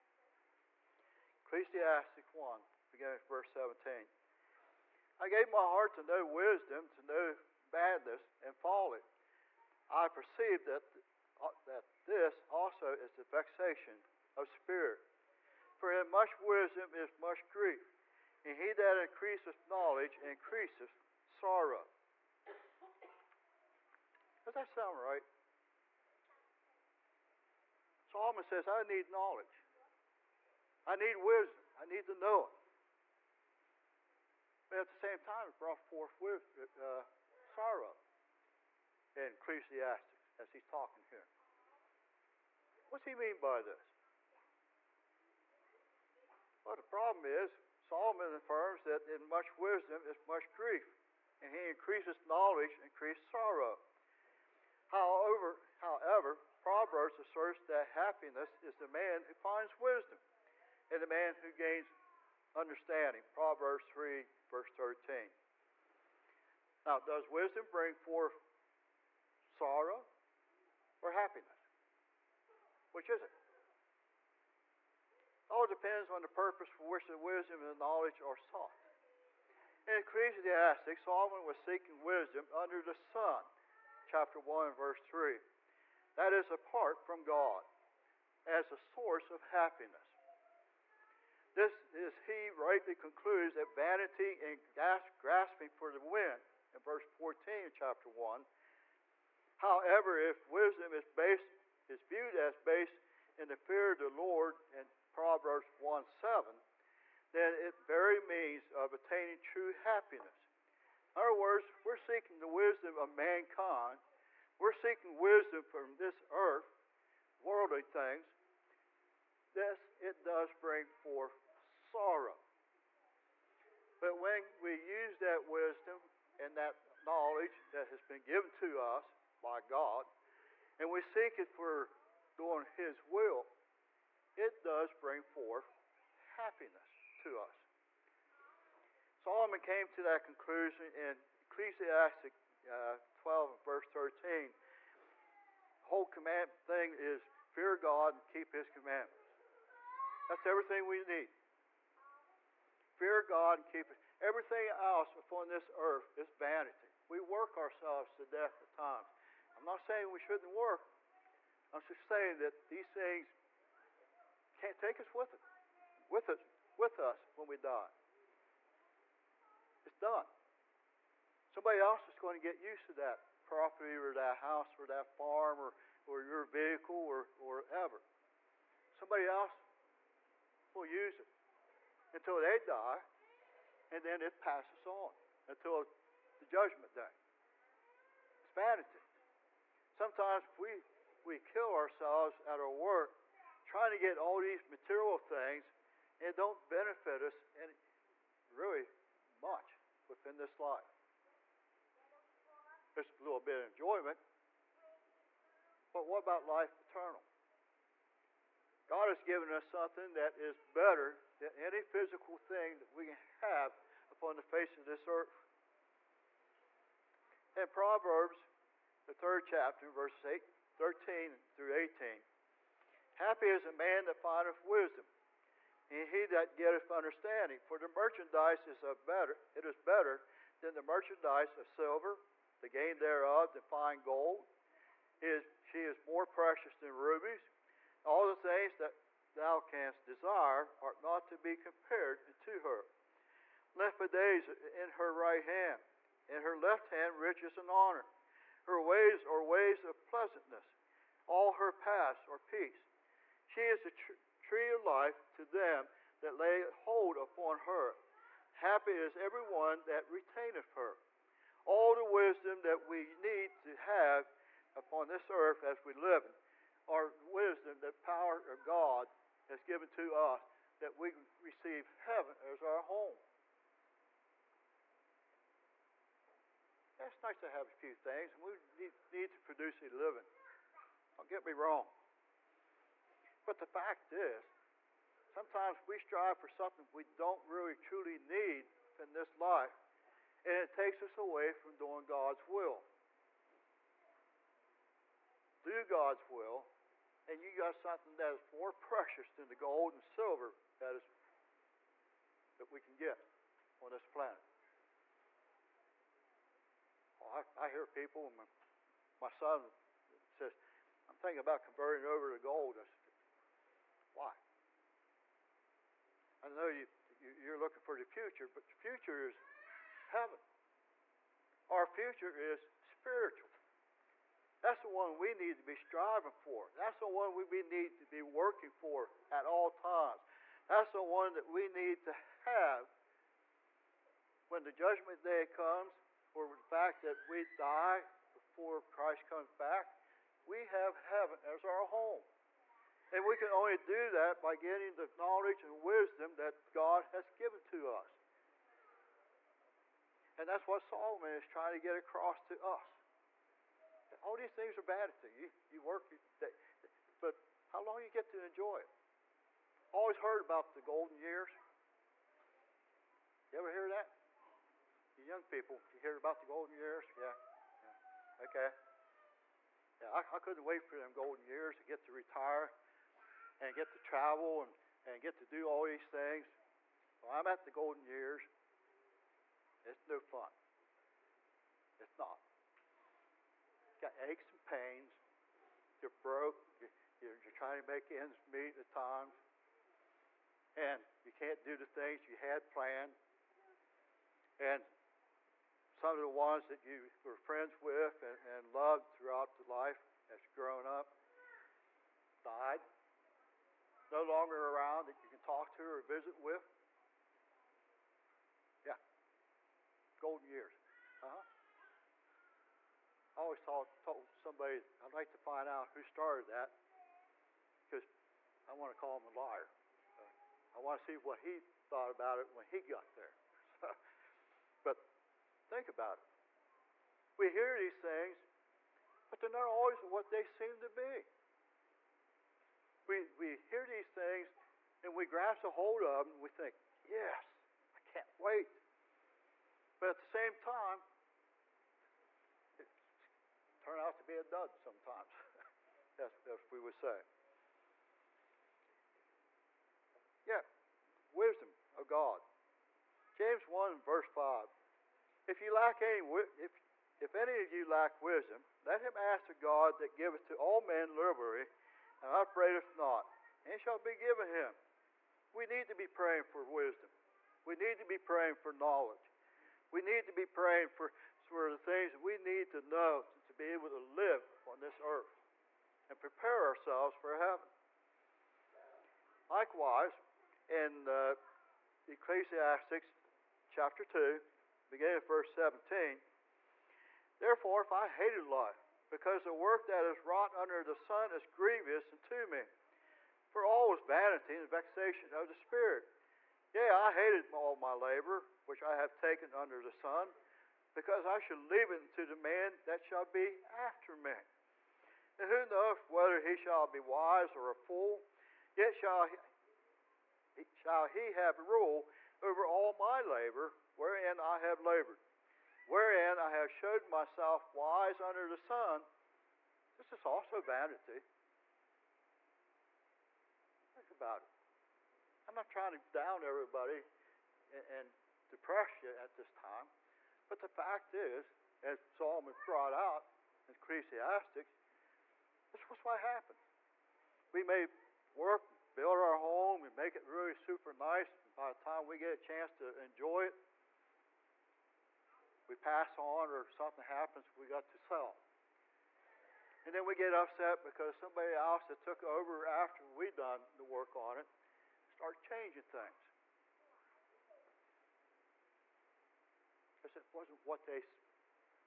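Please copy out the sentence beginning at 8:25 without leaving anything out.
And who knoweth whether he shall be wise or a fool?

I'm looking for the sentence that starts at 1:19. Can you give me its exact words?
In Ecclesiastes, Solomon was seeking wisdom under the sun chapter 1 verse 3.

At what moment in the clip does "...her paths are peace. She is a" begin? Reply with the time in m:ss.
4:11.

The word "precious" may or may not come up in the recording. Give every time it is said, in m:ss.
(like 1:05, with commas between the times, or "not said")
3:56, 4:58.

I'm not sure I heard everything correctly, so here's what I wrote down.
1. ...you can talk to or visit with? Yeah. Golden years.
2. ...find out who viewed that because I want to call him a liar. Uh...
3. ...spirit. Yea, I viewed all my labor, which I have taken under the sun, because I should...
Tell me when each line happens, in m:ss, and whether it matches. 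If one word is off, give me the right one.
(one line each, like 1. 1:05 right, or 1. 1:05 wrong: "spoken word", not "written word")
1. 6:45 right
2. 6:55 wrong: "started", not "viewed"
3. 8:15 wrong: "hated", not "viewed".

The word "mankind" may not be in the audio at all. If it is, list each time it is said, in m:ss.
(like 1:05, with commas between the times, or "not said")
1:53.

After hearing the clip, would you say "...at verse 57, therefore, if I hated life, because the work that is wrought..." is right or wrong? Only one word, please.
wrong.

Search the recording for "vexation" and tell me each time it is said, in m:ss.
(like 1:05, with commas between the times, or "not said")
0:13, 8:14.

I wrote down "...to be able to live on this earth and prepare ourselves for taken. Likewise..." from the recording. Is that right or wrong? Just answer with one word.
wrong.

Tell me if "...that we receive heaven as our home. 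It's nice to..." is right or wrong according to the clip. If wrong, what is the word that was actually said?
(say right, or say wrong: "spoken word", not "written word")
right.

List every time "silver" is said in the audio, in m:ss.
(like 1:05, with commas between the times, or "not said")
3:51, 5:00.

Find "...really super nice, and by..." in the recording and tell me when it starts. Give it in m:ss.
9:00.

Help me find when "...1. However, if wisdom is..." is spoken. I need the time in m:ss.
1:38.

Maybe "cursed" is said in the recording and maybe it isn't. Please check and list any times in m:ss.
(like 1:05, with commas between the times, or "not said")
not said.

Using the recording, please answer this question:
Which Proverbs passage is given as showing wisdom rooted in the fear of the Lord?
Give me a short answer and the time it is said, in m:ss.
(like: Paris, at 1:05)
Proverbs 1:7, at 1:45.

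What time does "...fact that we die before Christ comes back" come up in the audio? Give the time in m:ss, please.
5:36.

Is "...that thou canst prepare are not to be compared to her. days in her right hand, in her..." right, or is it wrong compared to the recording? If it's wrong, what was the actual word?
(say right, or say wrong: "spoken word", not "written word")
wrong: "desire", not "prepare".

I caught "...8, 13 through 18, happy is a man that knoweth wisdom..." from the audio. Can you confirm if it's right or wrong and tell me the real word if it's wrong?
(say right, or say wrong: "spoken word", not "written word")
wrong: "findeth", not "knoweth".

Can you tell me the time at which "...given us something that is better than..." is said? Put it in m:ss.
3:29.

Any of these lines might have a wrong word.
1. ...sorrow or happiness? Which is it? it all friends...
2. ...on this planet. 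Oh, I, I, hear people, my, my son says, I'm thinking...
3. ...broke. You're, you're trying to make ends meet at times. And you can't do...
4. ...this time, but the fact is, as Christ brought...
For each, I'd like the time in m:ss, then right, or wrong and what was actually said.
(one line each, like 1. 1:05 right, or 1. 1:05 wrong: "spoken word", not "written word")
1. 1:09 wrong: "depends", not "friends"
2. 5:03 right
3. 6:26 right
4. 8:49 wrong: "Solomon", not "Christ".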